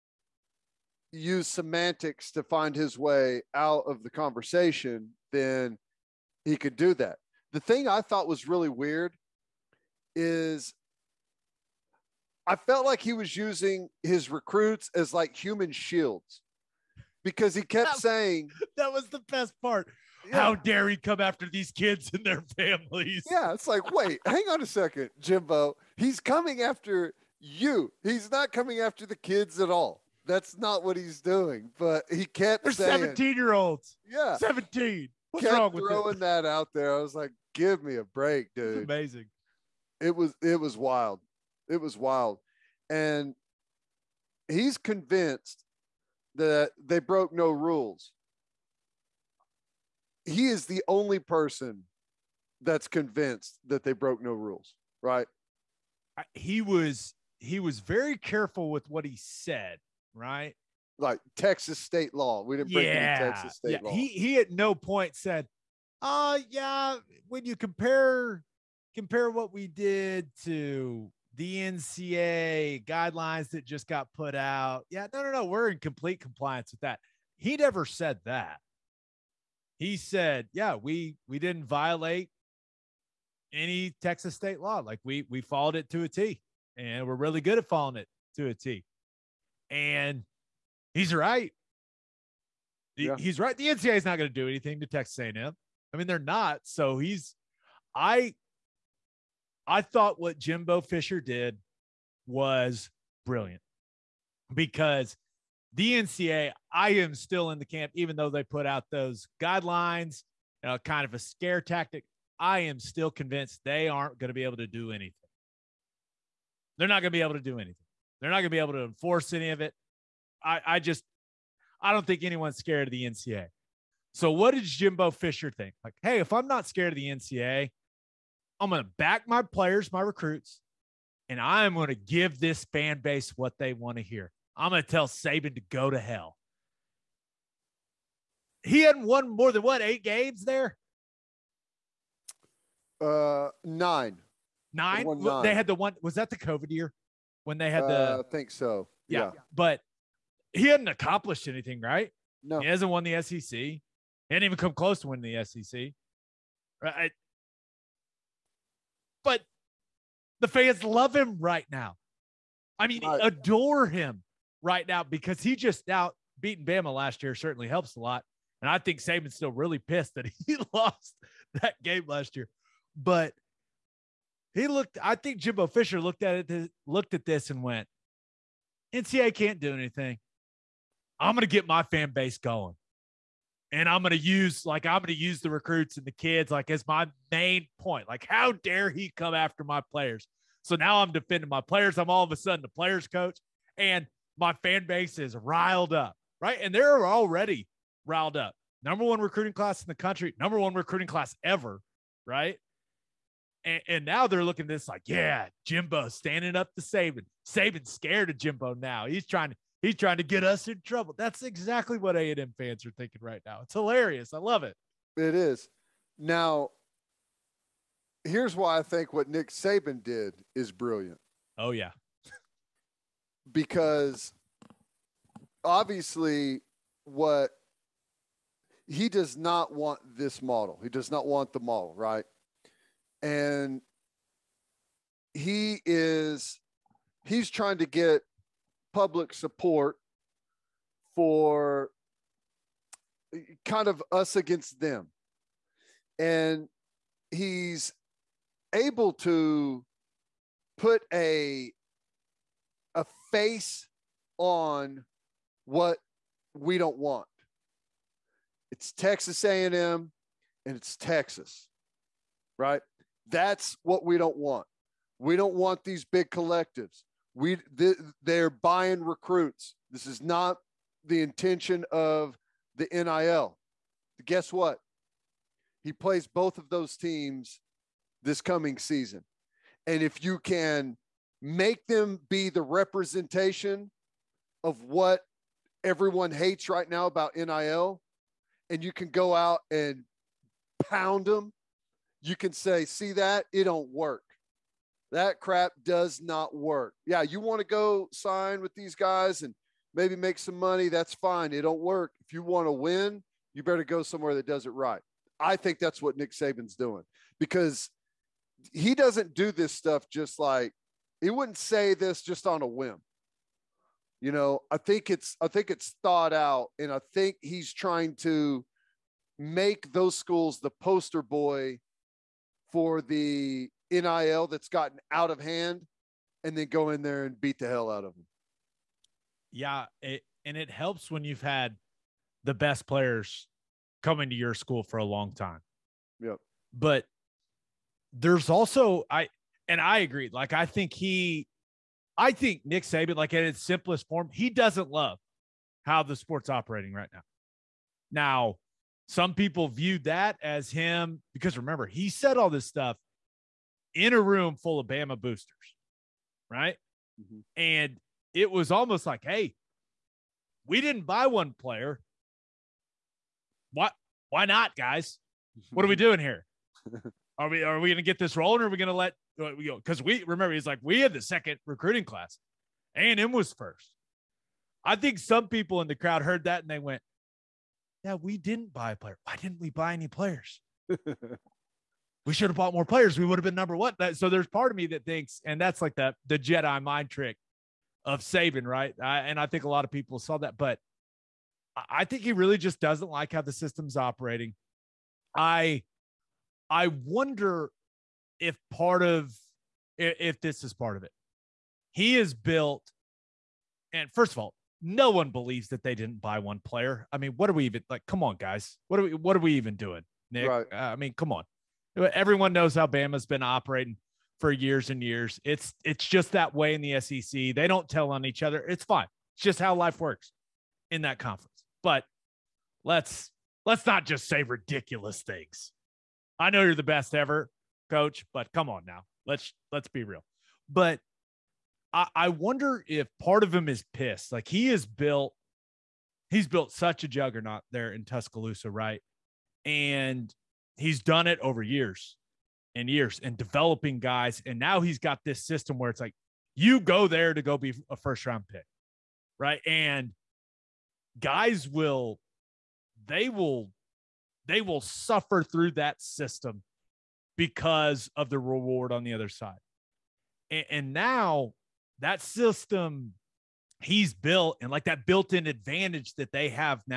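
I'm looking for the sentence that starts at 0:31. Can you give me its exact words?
But he kept They're saying, 17 year olds.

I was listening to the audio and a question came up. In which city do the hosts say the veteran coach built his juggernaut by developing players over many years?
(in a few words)
Tuscaloosa.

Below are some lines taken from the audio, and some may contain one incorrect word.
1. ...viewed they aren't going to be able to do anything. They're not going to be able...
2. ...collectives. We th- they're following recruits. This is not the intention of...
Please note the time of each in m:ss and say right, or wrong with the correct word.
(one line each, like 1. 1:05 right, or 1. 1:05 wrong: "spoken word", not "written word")
1. 1:53 wrong: "convinced", not "viewed"
2. 4:26 wrong: "buying", not "following".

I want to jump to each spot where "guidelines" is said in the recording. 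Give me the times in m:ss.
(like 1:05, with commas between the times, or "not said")
1:12, 1:49.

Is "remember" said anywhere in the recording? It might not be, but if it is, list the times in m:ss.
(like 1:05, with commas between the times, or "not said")
5:51, 6:10.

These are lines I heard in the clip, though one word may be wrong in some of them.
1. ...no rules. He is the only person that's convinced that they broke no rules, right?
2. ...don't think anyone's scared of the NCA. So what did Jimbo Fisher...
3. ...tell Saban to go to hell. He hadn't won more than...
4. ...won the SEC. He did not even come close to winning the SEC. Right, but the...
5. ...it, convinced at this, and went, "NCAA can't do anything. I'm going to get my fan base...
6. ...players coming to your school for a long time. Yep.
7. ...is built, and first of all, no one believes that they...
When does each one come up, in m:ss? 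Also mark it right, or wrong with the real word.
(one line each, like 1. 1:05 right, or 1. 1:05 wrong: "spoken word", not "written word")
1. 0:47 right
2. 2:01 right
3. 2:14 right
4. 2:32 right
5. 2:56 wrong: "looked", not "convinced"
6. 5:32 right
7. 6:42 right.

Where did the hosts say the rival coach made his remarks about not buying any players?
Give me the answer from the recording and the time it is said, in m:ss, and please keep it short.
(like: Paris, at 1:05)
a room full of Bama boosters, at 5:54.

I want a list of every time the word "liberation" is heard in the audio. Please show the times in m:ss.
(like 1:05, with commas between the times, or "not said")
not said.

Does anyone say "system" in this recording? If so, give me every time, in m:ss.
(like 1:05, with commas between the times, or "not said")
6:33, 7:25, 7:36, 7:42.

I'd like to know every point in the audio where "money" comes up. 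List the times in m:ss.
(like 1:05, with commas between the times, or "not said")
5:00.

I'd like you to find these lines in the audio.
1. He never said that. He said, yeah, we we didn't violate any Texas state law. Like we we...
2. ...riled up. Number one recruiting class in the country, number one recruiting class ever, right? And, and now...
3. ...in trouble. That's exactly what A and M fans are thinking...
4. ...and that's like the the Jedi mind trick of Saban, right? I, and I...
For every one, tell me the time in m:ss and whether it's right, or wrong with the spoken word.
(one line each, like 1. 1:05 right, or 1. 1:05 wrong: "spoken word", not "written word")
1. 1:17 right
2. 3:18 right
3. 3:30 right
4. 6:25 right.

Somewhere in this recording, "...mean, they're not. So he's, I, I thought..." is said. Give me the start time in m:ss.
1:35.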